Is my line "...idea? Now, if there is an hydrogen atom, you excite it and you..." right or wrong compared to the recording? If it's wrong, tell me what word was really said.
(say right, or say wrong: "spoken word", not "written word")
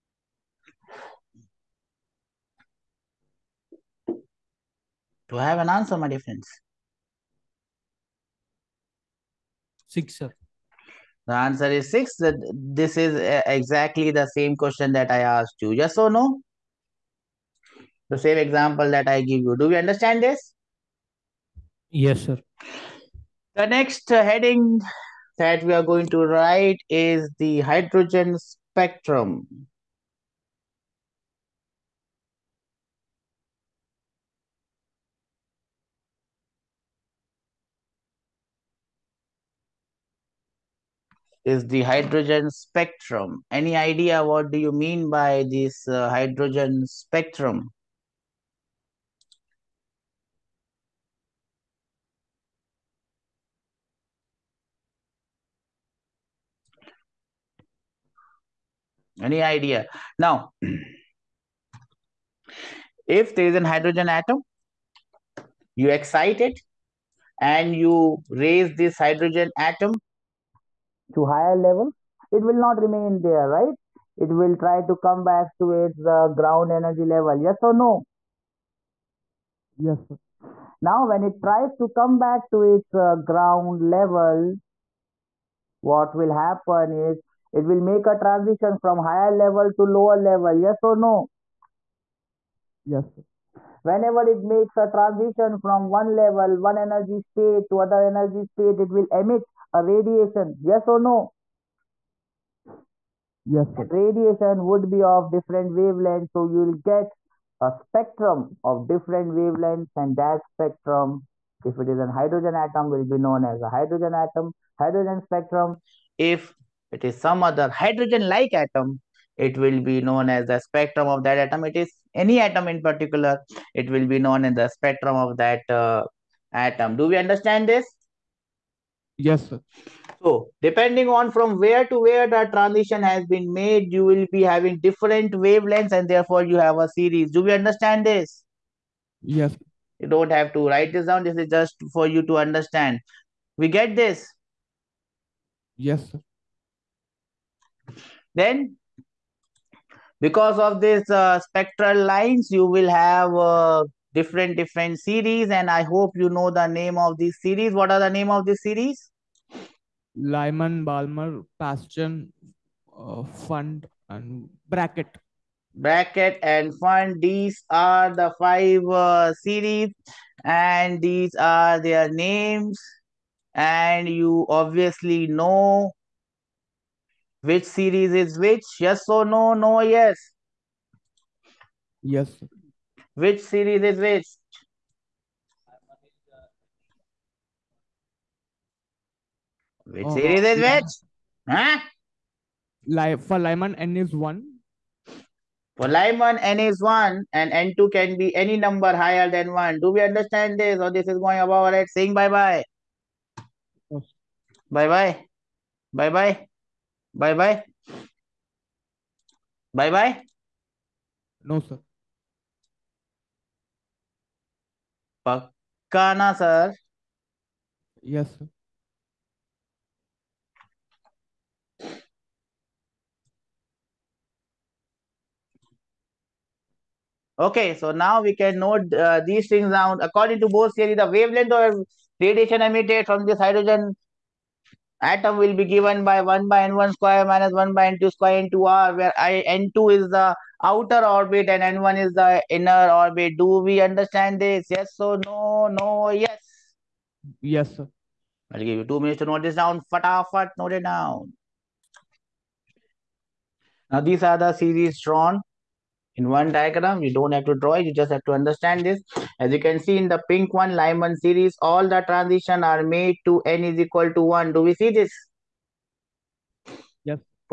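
right.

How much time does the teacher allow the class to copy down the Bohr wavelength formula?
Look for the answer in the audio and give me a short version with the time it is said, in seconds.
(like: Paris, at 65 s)
2 minutes, at 248 s.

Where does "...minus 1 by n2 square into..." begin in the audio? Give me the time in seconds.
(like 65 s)
237 s.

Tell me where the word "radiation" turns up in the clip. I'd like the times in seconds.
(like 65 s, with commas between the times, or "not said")
99 s, 103 s, 232 s.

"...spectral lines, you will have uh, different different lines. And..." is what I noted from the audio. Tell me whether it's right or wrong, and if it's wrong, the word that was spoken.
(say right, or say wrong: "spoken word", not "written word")
wrong: "series", not "lines".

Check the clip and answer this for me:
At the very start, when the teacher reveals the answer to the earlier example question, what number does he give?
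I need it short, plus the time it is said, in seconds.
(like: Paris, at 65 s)
6, at 11 s.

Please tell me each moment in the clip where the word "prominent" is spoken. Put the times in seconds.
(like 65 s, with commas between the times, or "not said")
not said.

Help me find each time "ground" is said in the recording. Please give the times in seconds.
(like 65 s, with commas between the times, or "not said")
76 s, 83 s.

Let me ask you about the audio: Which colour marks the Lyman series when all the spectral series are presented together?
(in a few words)
Pink.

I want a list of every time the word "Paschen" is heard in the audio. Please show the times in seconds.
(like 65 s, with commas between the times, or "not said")
161 s.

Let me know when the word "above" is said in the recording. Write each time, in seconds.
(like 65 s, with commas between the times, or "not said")
201 s.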